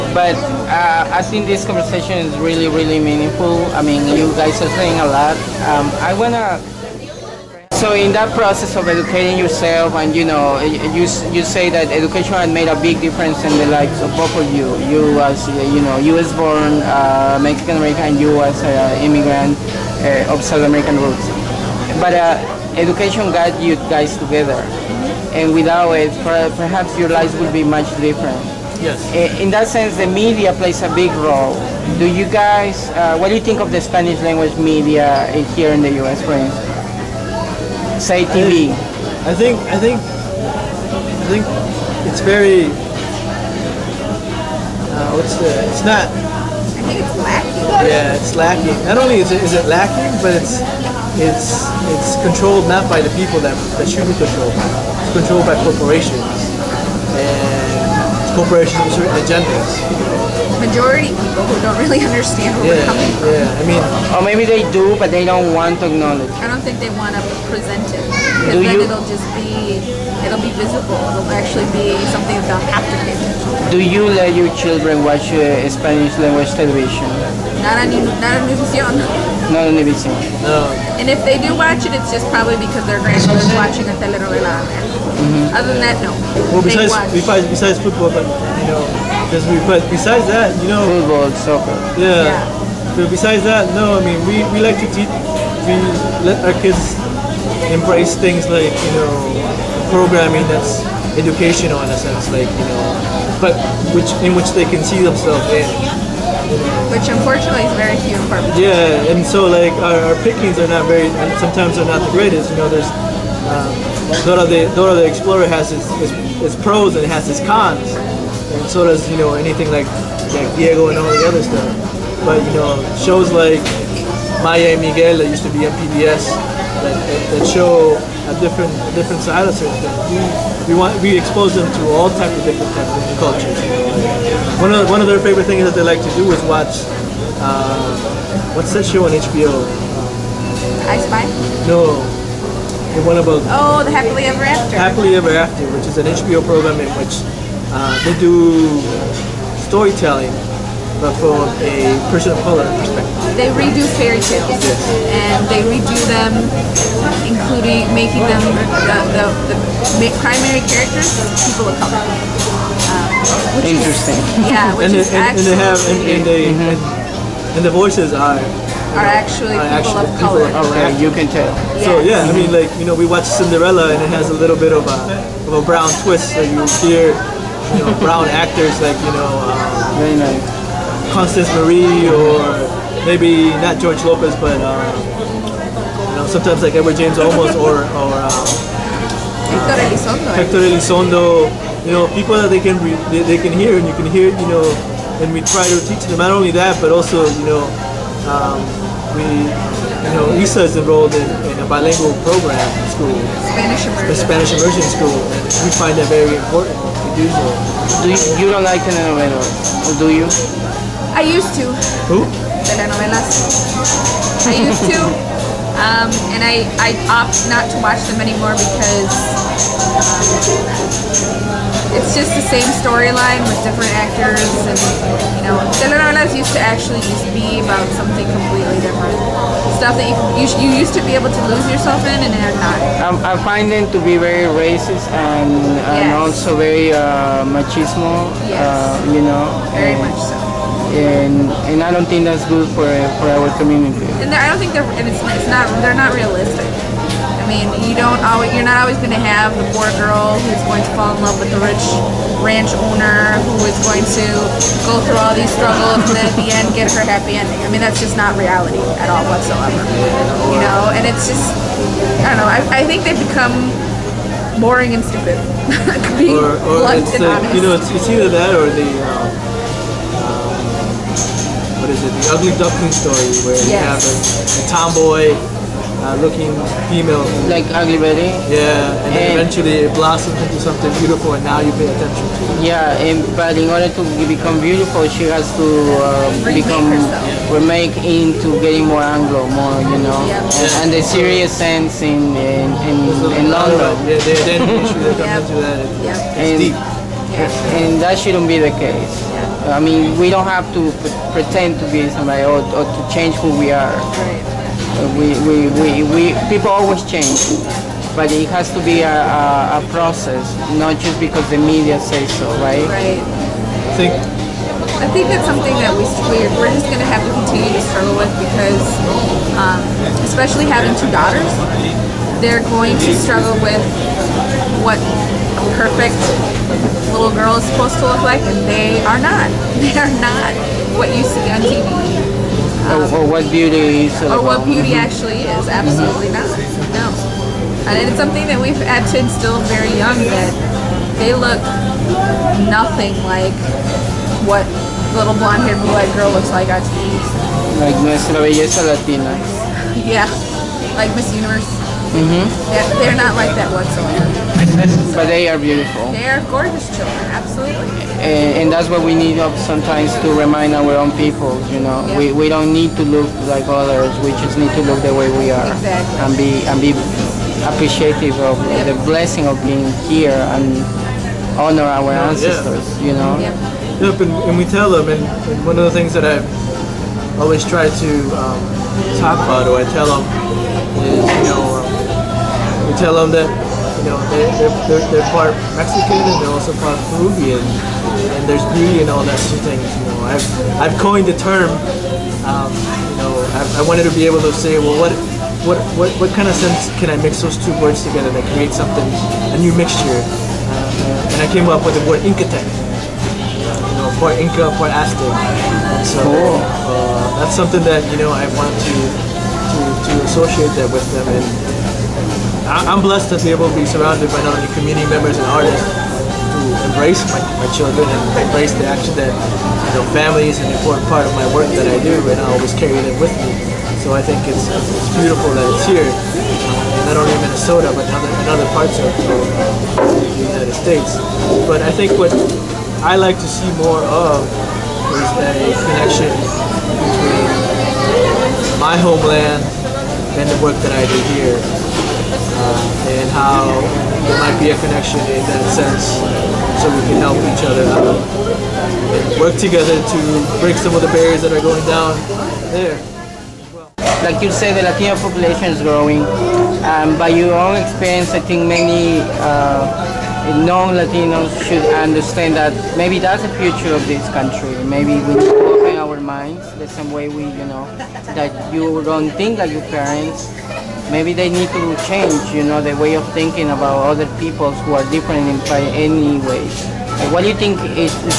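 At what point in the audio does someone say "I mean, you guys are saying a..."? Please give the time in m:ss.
0:03.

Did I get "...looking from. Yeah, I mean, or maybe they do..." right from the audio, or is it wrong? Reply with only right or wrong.
wrong.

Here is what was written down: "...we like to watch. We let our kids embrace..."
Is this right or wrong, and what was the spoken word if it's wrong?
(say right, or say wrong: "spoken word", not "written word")
wrong: "teach", not "watch".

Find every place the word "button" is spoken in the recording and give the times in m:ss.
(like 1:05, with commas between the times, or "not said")
not said.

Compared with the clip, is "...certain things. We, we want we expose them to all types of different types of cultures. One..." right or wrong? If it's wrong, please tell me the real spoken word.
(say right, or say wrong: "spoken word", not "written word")
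right.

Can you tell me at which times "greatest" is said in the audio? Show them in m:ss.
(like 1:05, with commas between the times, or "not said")
1:52.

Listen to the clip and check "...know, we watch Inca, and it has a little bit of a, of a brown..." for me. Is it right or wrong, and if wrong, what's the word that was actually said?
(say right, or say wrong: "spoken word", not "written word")
wrong: "Cinderella", not "Inca".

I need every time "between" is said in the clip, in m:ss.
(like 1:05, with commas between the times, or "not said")
1:48, 7:16.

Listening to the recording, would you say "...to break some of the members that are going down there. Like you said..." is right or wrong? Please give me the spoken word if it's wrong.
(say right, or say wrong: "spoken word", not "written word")
wrong: "barriers", not "members".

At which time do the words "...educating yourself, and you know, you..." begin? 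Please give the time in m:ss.
0:08.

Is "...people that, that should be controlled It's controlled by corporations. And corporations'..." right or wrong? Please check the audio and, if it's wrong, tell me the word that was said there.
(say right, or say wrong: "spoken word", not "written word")
right.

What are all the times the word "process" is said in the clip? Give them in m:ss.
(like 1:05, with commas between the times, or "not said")
0:08, 5:09.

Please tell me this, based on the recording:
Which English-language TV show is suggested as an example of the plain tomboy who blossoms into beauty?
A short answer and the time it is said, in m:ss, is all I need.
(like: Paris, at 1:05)
Ugly Betty, at 4:37.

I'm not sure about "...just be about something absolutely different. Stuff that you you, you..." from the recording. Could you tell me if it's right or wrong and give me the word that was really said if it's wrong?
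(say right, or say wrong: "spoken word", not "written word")
wrong: "completely", not "absolutely".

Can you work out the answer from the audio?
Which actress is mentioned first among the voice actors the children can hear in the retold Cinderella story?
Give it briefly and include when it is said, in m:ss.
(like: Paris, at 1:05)
Constance Marie, at 3:01.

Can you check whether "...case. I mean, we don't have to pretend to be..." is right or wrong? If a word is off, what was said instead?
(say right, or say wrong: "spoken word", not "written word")
right.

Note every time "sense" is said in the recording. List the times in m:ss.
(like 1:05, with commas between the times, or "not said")
0:29, 1:41, 4:51, 6:36, 7:25.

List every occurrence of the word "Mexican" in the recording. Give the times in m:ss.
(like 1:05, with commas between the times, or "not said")
0:17, 6:25.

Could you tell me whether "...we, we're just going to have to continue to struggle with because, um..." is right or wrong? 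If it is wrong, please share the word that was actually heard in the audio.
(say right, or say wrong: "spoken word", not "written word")
right.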